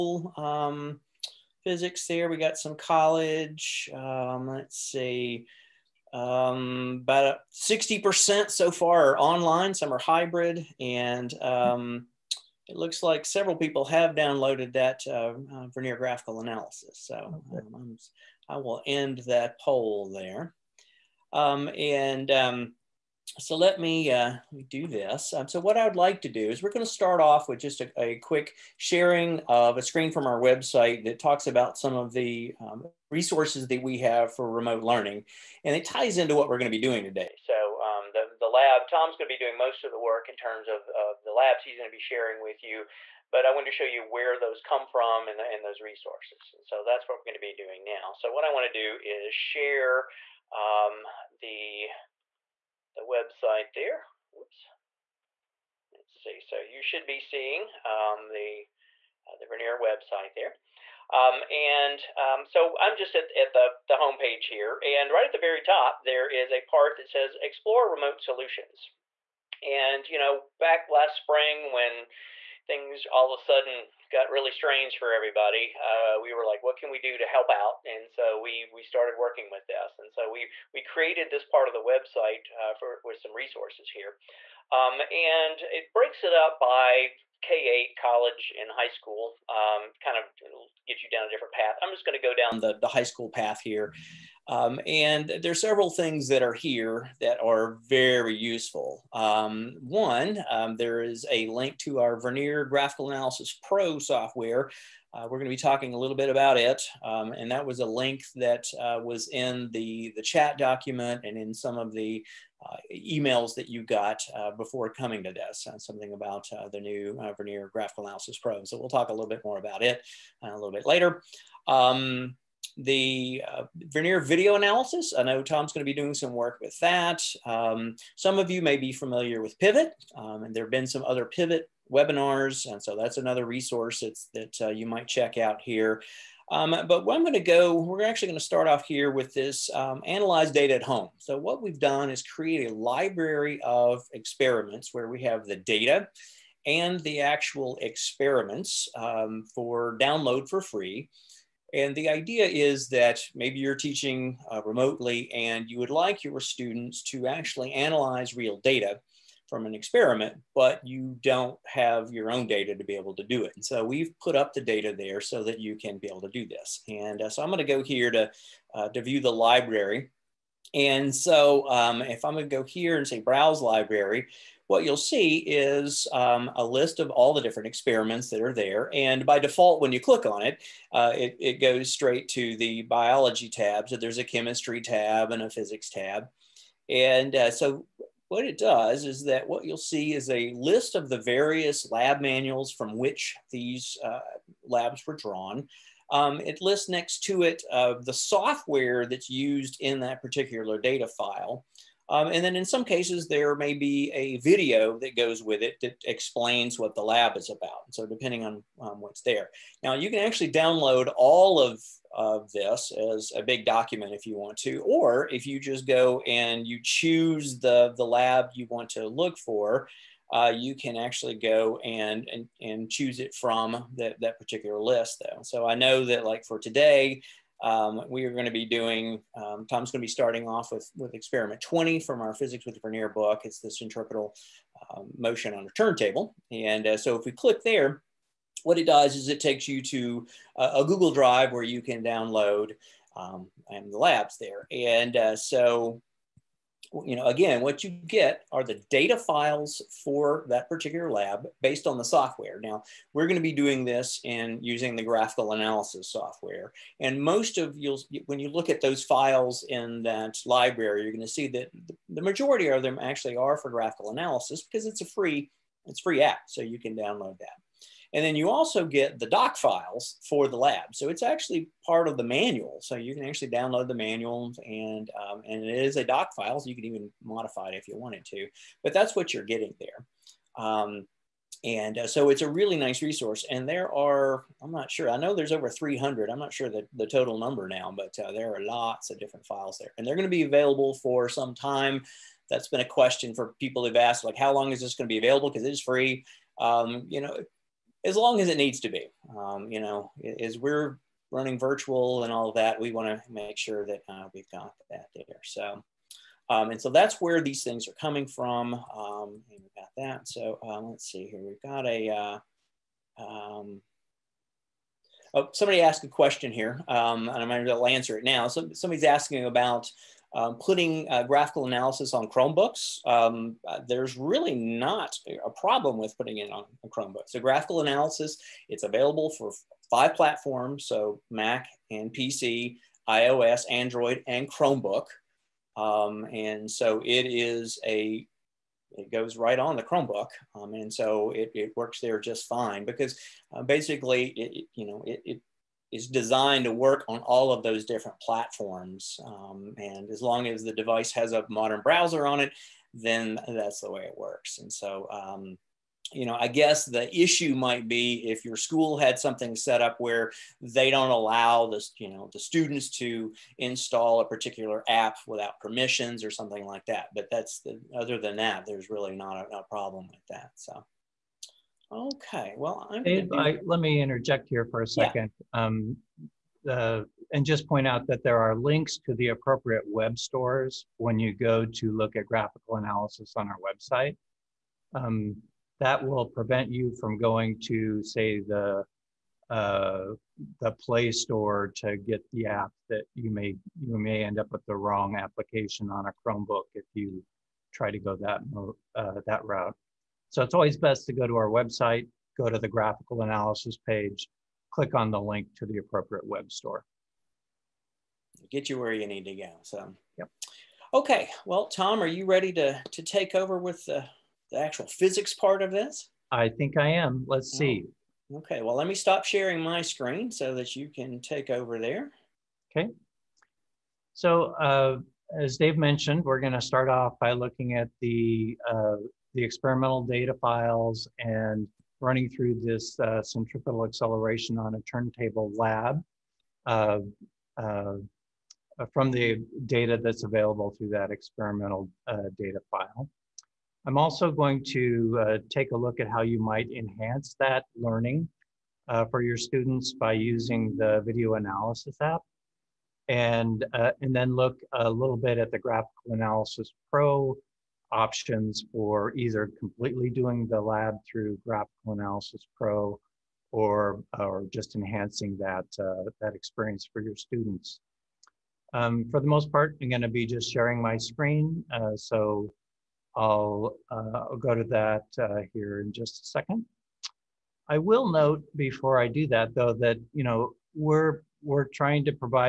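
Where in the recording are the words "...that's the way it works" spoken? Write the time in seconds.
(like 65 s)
353 s.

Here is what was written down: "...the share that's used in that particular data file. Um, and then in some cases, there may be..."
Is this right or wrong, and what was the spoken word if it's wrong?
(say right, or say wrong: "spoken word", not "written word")
wrong: "software", not "share".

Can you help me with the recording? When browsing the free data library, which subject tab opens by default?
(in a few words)
Biology.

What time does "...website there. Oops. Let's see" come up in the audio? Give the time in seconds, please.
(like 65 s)
53 s.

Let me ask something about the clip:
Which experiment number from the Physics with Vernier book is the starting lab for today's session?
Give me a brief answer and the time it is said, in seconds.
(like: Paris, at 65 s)
20, at 231 s.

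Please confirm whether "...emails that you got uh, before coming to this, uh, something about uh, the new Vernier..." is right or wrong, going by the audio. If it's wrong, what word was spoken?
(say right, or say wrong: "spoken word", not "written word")
right.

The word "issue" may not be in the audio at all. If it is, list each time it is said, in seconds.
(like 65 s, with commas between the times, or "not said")
357 s.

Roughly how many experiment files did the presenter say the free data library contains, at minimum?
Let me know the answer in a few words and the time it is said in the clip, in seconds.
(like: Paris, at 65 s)
Over 300, at 285 s.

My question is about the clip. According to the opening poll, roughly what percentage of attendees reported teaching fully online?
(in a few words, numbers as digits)
60%.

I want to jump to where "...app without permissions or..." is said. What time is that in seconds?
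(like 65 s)
364 s.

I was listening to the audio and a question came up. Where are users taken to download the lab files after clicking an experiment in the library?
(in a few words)
Google Drive.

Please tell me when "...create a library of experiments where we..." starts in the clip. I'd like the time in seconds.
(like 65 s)
142 s.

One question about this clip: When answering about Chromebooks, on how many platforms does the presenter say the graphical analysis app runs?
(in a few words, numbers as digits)
5.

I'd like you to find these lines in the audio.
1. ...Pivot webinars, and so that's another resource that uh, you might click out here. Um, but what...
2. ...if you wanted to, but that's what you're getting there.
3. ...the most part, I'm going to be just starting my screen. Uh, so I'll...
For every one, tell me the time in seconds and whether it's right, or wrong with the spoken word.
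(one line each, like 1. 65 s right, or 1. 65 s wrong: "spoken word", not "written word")
1. 131 s wrong: "check", not "click"
2. 277 s right
3. 469 s wrong: "sharing", not "starting".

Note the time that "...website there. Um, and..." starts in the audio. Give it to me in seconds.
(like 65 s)
59 s.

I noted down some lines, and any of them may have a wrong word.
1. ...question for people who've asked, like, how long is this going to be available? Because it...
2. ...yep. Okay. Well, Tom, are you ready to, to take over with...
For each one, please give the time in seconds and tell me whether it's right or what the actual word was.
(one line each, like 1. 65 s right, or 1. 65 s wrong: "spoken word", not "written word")
1. 292 s right
2. 410 s right.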